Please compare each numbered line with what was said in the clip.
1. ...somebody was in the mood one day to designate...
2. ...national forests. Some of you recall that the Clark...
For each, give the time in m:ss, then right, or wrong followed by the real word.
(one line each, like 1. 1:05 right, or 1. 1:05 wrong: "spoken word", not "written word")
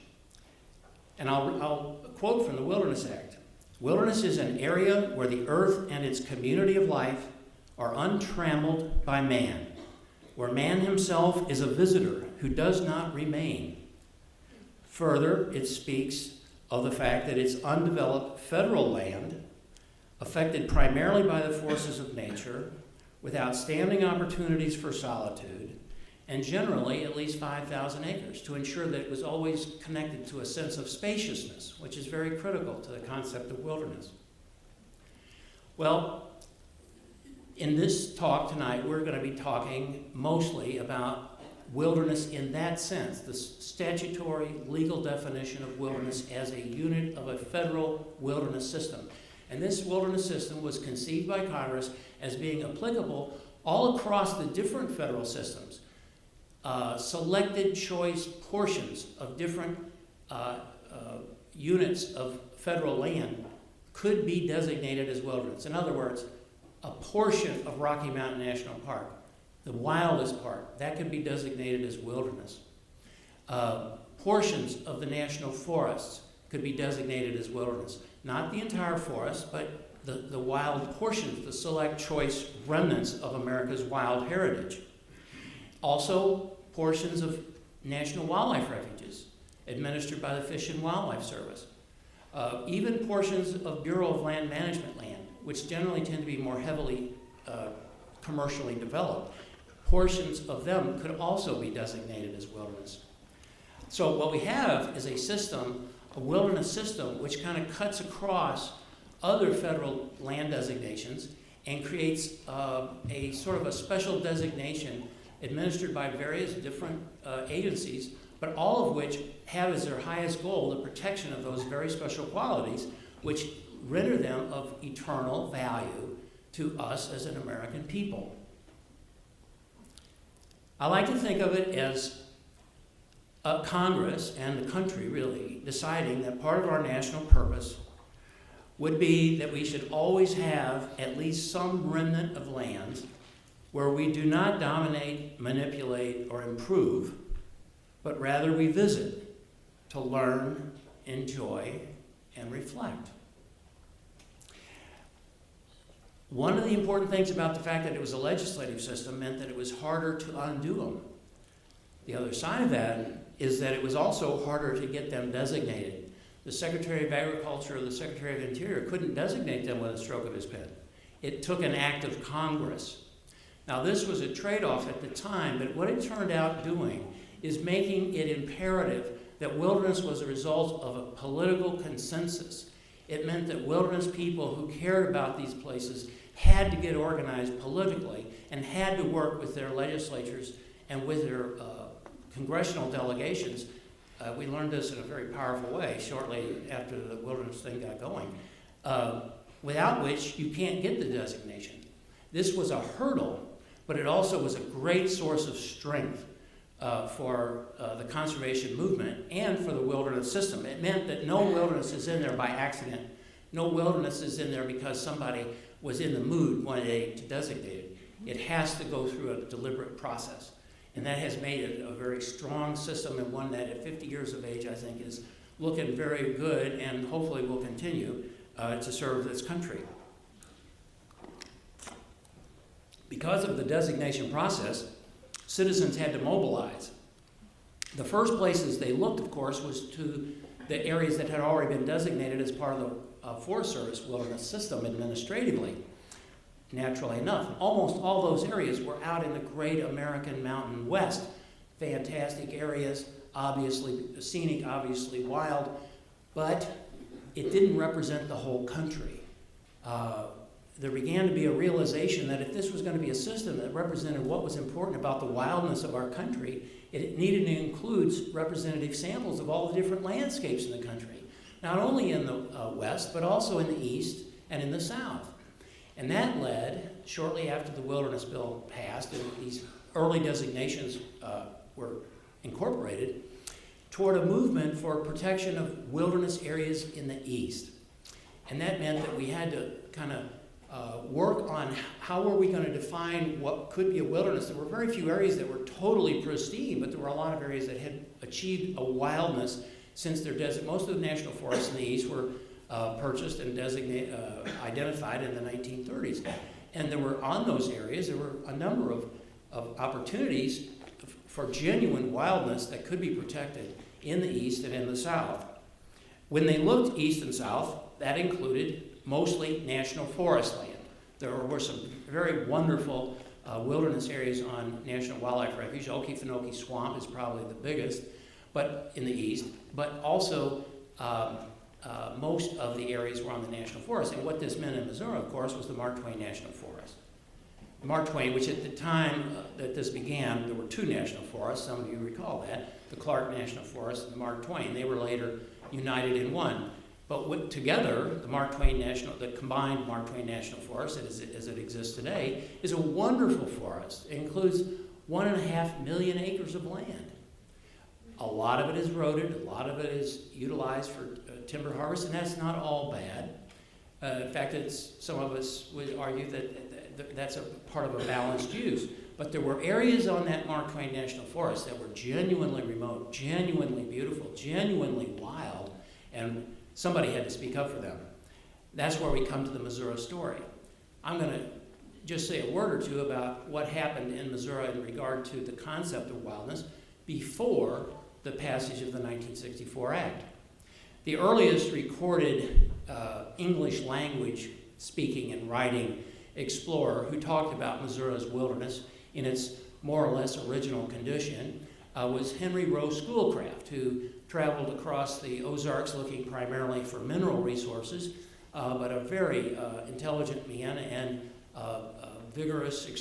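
1. 3:35 right
2. 5:40 right.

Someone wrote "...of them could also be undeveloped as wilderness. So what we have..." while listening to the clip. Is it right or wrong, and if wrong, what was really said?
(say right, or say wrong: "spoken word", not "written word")
wrong: "designated", not "undeveloped".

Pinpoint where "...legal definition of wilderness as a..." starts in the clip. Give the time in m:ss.
0:44.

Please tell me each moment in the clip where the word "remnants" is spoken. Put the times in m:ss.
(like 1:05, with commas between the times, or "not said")
1:22, 2:21.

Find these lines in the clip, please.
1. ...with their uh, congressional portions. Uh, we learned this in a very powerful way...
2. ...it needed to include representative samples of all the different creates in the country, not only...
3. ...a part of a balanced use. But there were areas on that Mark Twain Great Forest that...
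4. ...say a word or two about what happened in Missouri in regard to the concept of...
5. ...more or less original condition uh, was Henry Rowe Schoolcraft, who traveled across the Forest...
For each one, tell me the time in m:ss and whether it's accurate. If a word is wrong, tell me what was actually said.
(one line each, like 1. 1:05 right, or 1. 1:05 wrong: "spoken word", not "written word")
1. 3:11 wrong: "delegations", not "portions"
2. 4:26 wrong: "landscapes", not "creates"
3. 6:07 wrong: "National", not "Great"
4. 6:22 right
5. 6:39 wrong: "Ozarks", not "Forest".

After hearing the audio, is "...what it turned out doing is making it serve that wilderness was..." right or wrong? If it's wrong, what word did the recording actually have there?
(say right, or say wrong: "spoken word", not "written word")
wrong: "imperative", not "serve".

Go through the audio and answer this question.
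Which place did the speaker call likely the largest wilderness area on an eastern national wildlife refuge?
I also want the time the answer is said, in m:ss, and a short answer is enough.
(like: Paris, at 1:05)
Okefenokee Swamp, at 5:25.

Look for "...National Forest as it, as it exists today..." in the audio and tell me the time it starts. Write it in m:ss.
5:50.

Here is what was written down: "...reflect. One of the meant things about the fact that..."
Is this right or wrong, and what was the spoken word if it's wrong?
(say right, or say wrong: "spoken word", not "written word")
wrong: "important", not "meant".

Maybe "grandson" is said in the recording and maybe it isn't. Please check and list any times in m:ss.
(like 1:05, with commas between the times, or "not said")
not said.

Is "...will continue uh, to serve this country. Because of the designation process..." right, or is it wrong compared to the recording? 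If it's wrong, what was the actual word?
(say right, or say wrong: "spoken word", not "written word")
right.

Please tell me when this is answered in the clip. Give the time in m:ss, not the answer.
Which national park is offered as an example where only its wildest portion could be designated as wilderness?
1:07.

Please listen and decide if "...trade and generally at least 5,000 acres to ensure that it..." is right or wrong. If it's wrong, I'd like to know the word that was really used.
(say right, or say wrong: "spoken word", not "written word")
wrong: "solitude", not "trade".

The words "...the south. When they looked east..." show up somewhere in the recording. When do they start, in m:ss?
5:14.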